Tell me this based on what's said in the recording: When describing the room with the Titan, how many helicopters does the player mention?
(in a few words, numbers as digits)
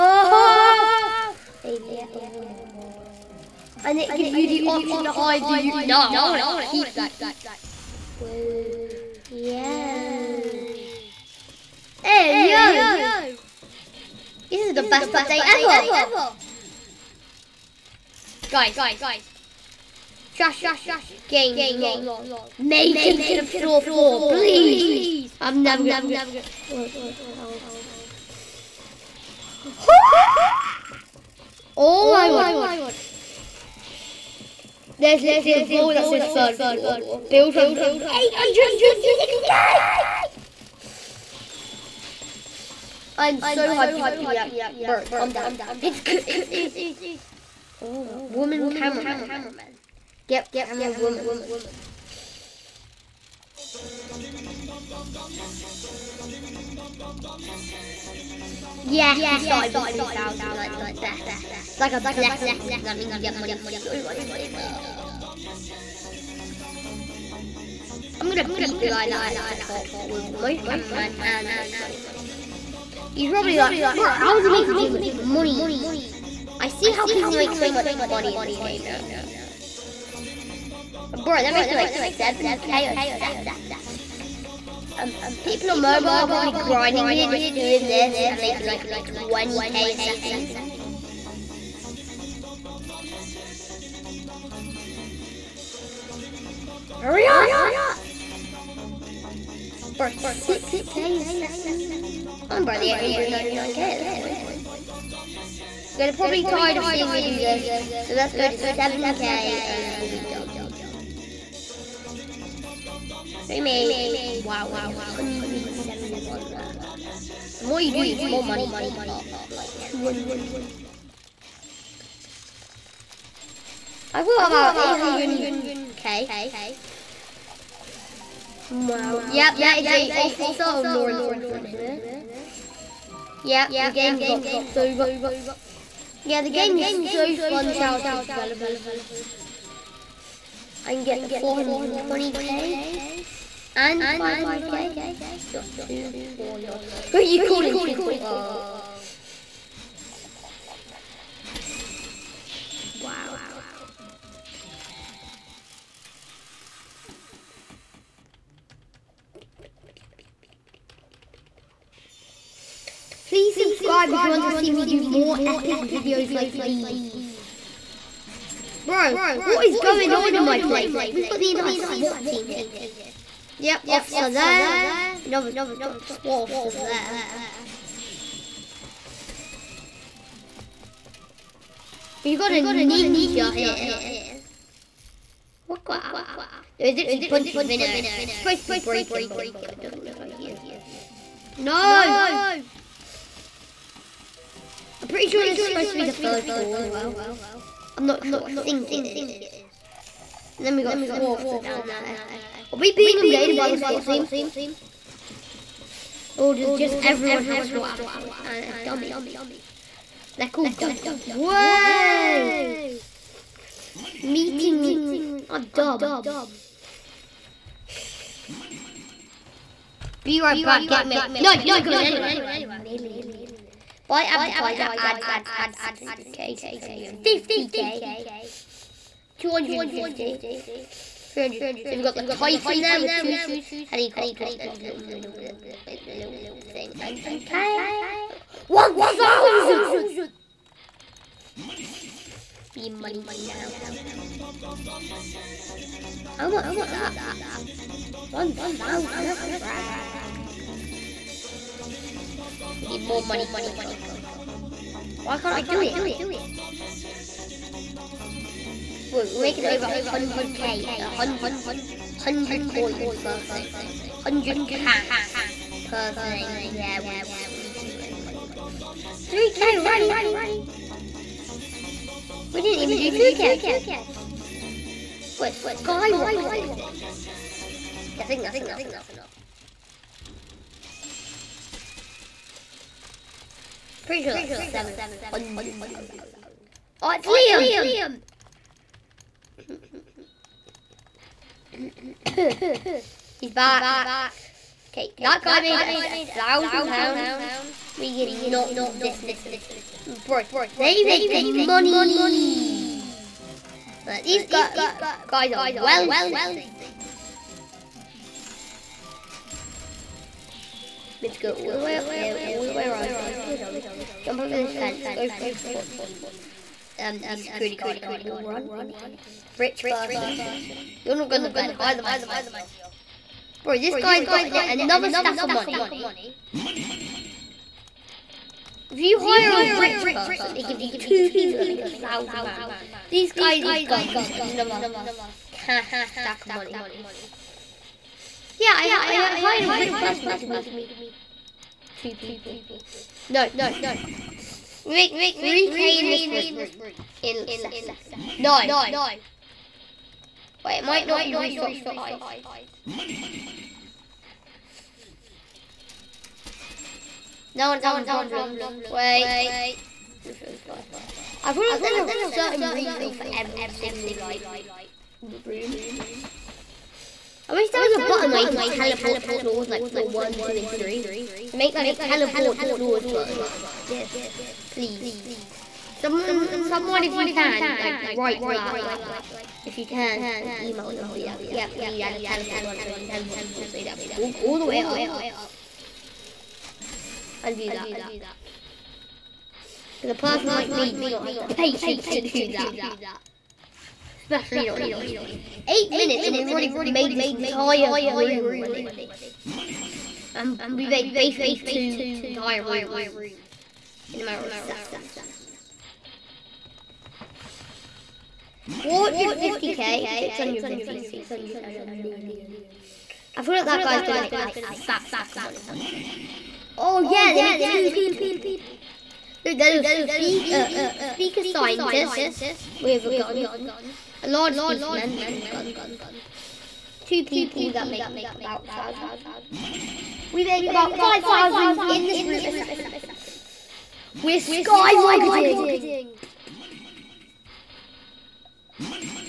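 2.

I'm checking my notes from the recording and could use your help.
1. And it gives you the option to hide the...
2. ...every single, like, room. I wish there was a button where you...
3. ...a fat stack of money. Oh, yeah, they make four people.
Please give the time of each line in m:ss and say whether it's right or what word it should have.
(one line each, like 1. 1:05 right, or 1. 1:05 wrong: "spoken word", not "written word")
1. 0:03 right
2. 6:03 right
3. 6:54 wrong: "two", not "four".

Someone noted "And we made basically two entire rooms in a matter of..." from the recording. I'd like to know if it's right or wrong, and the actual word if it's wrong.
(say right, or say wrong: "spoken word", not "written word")
right.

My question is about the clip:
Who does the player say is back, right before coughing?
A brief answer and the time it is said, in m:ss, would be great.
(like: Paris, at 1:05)
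Liam, at 4:47.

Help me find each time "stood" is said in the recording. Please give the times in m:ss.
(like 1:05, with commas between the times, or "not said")
not said.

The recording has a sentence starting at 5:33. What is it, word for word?
These guys with guns another cash stack of money.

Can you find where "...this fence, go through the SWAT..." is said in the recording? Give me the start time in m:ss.
5:14.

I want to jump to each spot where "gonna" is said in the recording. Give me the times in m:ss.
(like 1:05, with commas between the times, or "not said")
0:25.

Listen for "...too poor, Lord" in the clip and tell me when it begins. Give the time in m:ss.
2:25.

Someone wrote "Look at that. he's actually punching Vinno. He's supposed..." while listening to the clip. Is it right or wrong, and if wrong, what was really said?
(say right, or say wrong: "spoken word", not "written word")
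right.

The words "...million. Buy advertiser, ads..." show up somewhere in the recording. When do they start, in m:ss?
3:42.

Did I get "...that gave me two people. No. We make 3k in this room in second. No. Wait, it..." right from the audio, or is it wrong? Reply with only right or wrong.
right.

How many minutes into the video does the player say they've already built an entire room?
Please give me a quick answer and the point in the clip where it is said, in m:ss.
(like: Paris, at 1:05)
8, at 6:35.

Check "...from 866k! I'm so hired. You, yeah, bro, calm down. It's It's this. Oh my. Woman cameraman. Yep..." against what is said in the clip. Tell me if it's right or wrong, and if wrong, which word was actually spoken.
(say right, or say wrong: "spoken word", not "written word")
wrong: "hyped", not "hired".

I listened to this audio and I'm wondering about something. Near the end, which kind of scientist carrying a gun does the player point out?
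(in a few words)
Speaker scientist.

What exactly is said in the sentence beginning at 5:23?
Bro, this guy's got another stack of money.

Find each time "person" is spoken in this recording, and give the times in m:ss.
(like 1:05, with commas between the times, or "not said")
5:19, 5:30, 5:39, 6:30.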